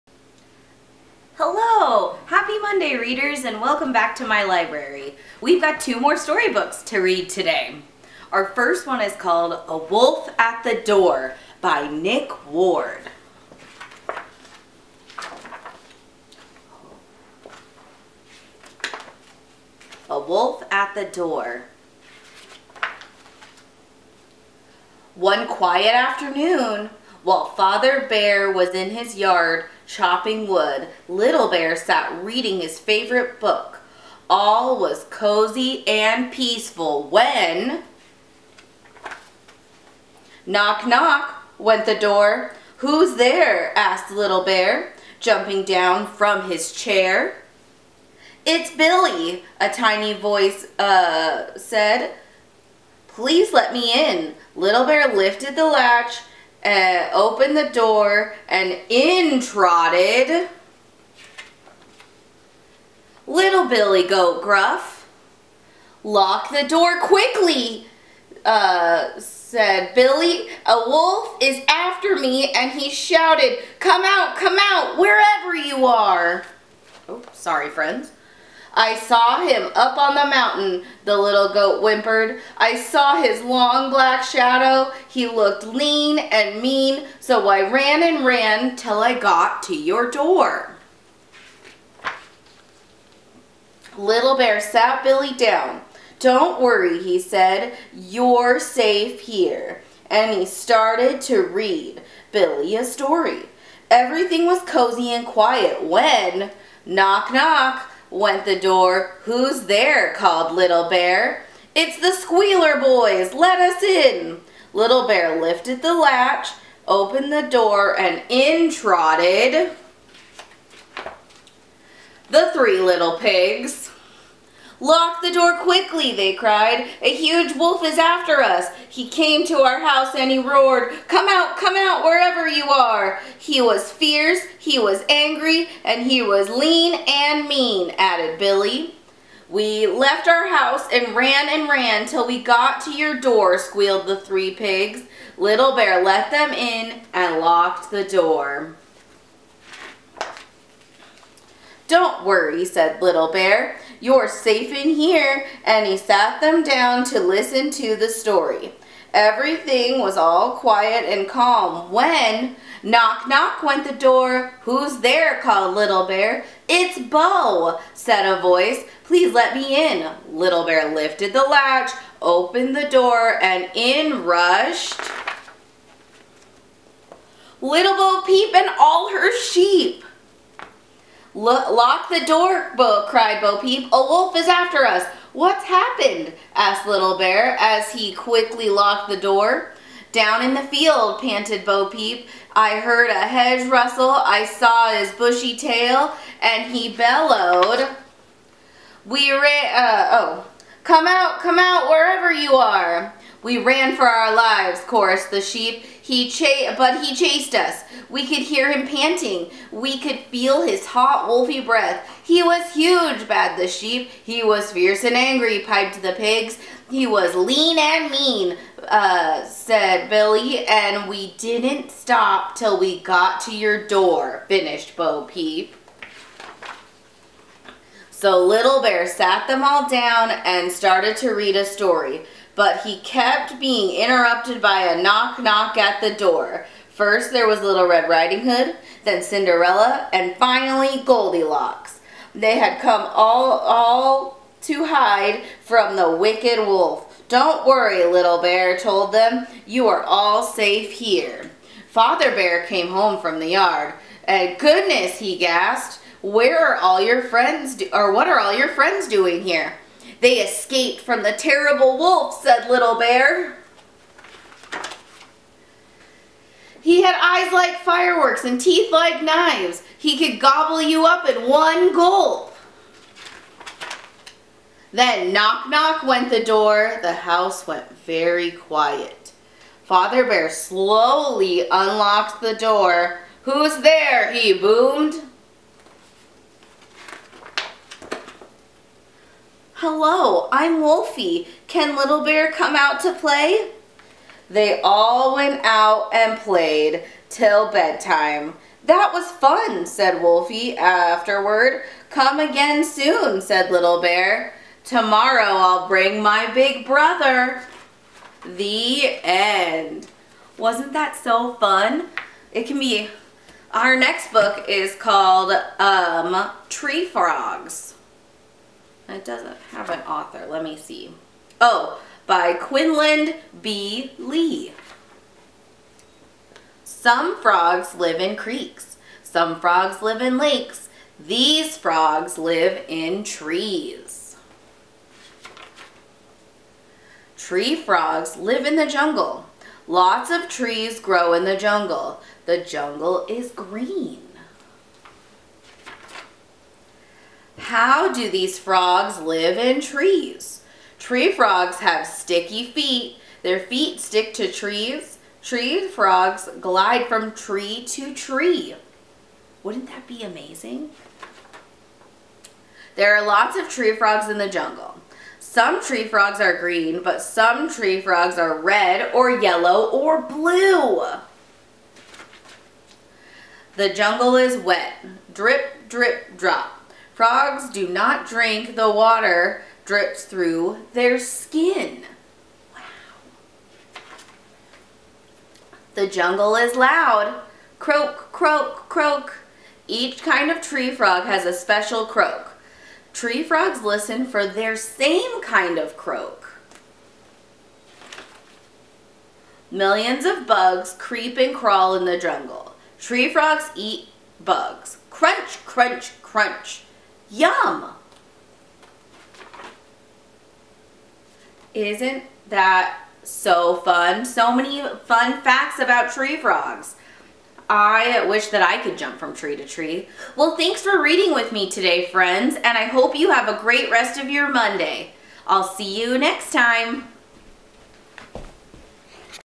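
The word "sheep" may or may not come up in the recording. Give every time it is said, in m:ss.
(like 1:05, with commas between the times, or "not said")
2:59, 3:25, 3:33.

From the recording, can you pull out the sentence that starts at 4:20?
They escaped from the terrible wolf, said Little Bear.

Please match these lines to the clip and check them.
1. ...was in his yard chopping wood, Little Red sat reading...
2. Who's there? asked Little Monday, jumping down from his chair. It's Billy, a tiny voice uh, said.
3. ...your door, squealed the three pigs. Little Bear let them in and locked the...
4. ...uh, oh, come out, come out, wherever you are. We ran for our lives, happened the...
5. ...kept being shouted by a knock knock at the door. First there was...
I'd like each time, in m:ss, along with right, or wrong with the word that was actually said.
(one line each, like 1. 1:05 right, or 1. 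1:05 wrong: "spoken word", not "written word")
1. 0:28 wrong: "Bear", not "Red"
2. 0:42 wrong: "Bear", not "Monday"
3. 2:22 right
4. 3:19 wrong: "chorused", not "happened"
5. 3:53 wrong: "interrupted", not "shouted".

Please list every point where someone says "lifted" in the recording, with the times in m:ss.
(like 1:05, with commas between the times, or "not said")
0:55, 1:55, 2:50.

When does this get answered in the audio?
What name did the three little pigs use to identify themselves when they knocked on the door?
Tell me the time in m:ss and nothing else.
1:51.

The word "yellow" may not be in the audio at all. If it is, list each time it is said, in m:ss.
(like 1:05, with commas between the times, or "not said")
6:09.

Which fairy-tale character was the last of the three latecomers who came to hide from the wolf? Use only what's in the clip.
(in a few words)
Goldilocks.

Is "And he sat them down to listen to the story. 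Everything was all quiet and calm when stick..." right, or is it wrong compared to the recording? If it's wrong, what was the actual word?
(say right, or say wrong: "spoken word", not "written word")
wrong: "knock", not "stick".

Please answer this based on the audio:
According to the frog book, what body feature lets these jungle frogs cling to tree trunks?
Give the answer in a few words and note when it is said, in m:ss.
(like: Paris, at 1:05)
Sticky feet, at 5:52.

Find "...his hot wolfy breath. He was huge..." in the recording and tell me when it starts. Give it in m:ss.
3:30.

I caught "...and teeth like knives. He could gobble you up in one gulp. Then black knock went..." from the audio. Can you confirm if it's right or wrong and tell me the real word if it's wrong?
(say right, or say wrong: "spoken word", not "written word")
wrong: "knock", not "black".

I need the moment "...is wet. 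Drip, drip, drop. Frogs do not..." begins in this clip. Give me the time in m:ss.
6:14.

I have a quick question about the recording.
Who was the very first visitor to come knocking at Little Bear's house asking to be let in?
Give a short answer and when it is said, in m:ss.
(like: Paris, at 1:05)
Billy Goat Gruff, at 1:03.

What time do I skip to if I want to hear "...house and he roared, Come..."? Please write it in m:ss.
2:09.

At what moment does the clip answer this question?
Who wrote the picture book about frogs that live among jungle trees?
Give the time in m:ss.
5:22.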